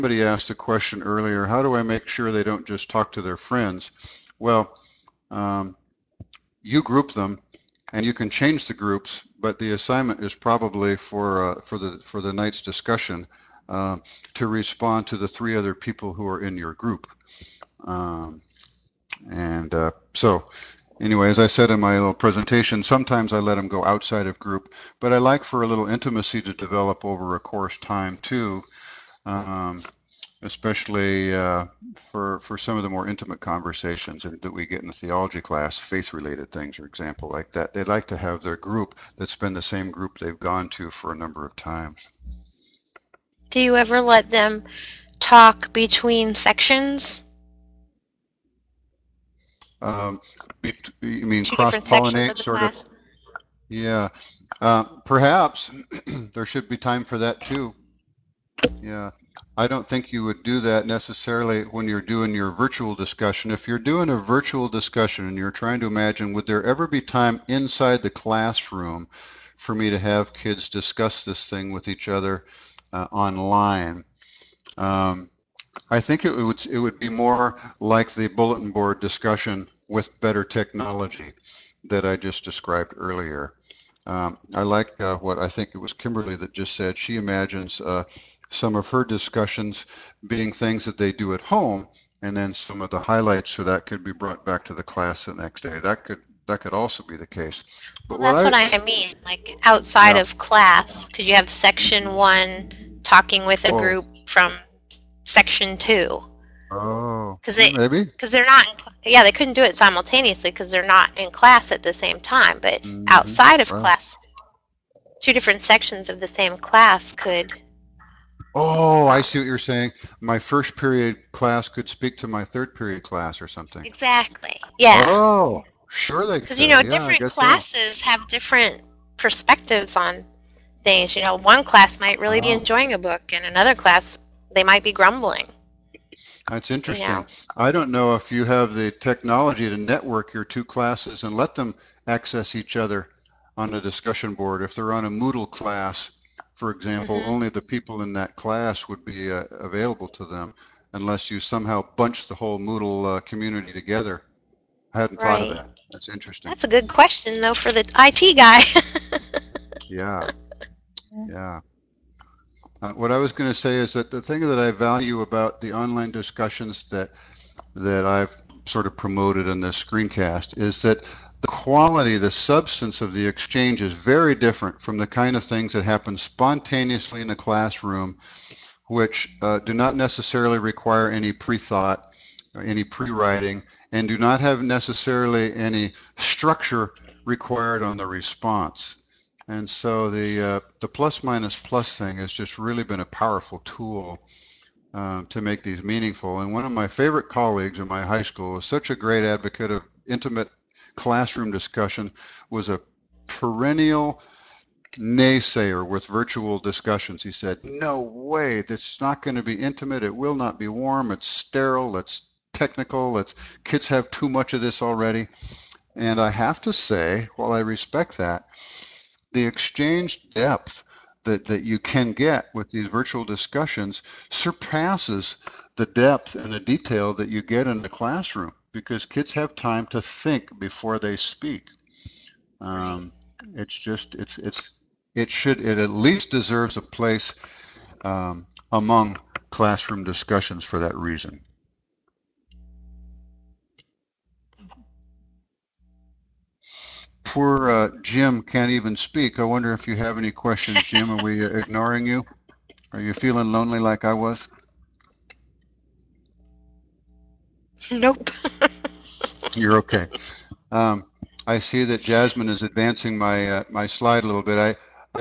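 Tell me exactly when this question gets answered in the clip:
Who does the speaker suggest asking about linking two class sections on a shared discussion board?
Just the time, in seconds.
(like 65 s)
157 s.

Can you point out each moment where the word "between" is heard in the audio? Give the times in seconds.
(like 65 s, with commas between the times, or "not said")
45 s.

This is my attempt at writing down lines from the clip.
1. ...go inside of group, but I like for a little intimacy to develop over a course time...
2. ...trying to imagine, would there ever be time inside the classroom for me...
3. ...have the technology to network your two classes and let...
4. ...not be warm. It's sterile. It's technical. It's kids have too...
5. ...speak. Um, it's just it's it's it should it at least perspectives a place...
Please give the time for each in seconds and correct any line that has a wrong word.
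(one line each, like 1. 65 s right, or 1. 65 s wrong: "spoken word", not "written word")
1. 23 s wrong: "outside", not "inside"
2. 65 s right
3. 138 s right
4. 210 s right
5. 231 s wrong: "deserves", not "perspectives".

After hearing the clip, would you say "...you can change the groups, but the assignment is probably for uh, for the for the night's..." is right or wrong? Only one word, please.
right.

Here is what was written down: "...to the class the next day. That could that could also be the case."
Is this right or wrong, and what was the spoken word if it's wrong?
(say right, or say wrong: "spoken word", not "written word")
right.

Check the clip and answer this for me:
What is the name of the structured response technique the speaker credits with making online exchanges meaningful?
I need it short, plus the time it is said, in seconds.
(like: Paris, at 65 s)
Plus minus plus, at 190 s.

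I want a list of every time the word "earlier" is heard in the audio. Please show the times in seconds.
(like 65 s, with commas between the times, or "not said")
1 s, 82 s.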